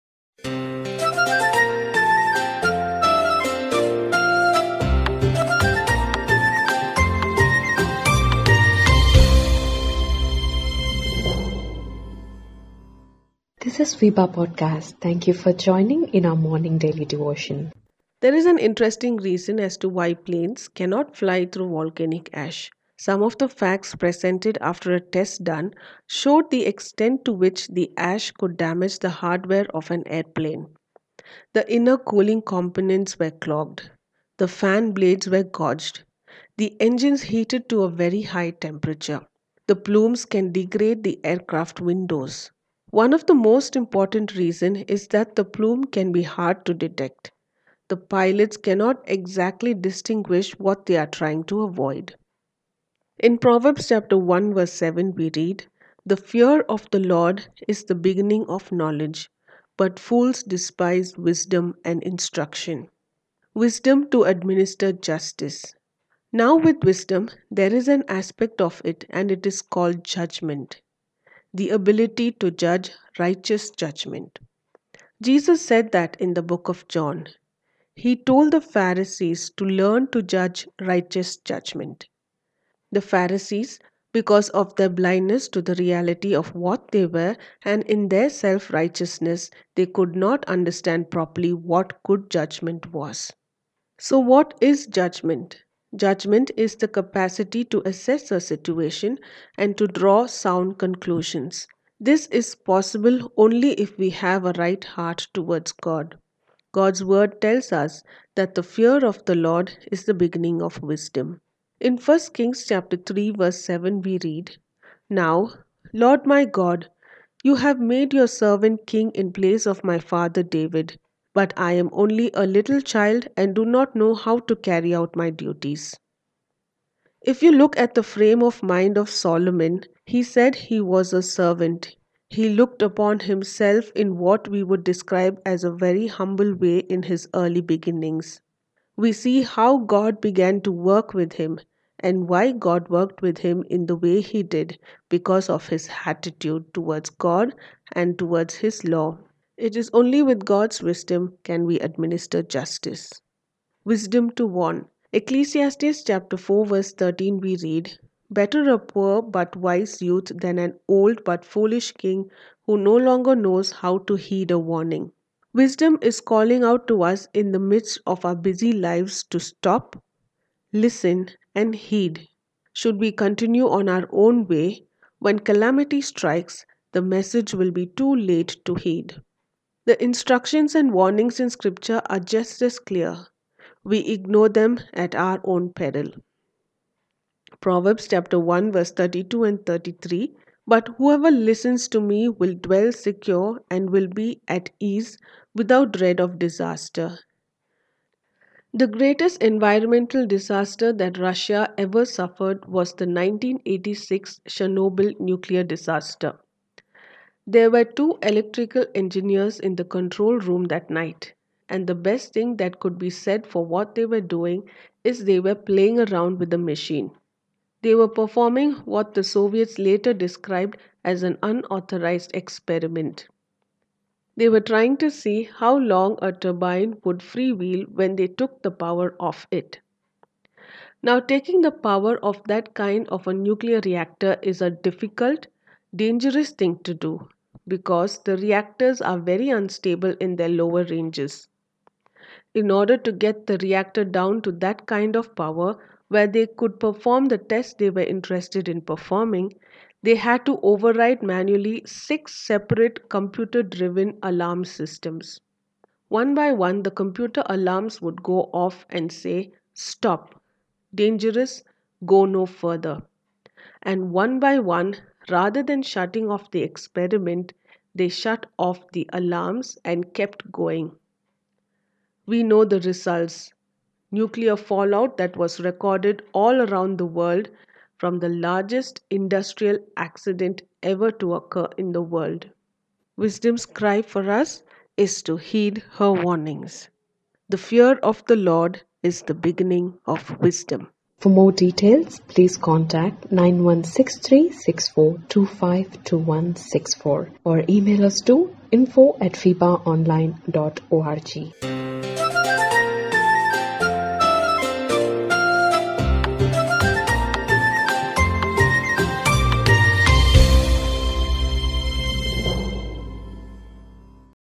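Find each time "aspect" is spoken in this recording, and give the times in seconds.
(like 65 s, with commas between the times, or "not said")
68 s.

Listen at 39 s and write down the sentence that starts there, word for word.
The plumes can degrade the aircraft windows.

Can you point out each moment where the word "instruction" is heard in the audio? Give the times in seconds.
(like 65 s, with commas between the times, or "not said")
62 s, 180 s.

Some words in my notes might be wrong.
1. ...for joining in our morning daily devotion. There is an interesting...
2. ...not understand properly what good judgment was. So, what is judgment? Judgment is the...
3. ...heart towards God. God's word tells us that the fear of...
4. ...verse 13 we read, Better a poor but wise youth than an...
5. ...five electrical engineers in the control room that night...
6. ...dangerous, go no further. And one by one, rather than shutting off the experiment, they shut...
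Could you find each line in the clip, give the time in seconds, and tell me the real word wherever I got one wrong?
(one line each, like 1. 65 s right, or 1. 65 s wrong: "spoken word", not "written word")
1. 15 s right
2. 90 s right
3. 104 s right
4. 156 s right
5. 207 s wrong: "two", not "five"
6. 260 s right.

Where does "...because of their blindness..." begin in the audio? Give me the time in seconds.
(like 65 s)
84 s.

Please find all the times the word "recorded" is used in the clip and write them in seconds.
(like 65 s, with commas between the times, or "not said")
275 s.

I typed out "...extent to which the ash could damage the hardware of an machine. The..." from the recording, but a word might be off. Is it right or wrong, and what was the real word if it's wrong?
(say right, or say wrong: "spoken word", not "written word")
wrong: "airplane", not "machine".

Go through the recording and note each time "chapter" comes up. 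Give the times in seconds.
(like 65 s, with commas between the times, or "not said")
53 s, 112 s, 156 s, 188 s.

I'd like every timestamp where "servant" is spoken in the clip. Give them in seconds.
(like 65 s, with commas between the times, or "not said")
118 s, 131 s.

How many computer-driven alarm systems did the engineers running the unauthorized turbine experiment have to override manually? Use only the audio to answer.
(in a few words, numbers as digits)
6.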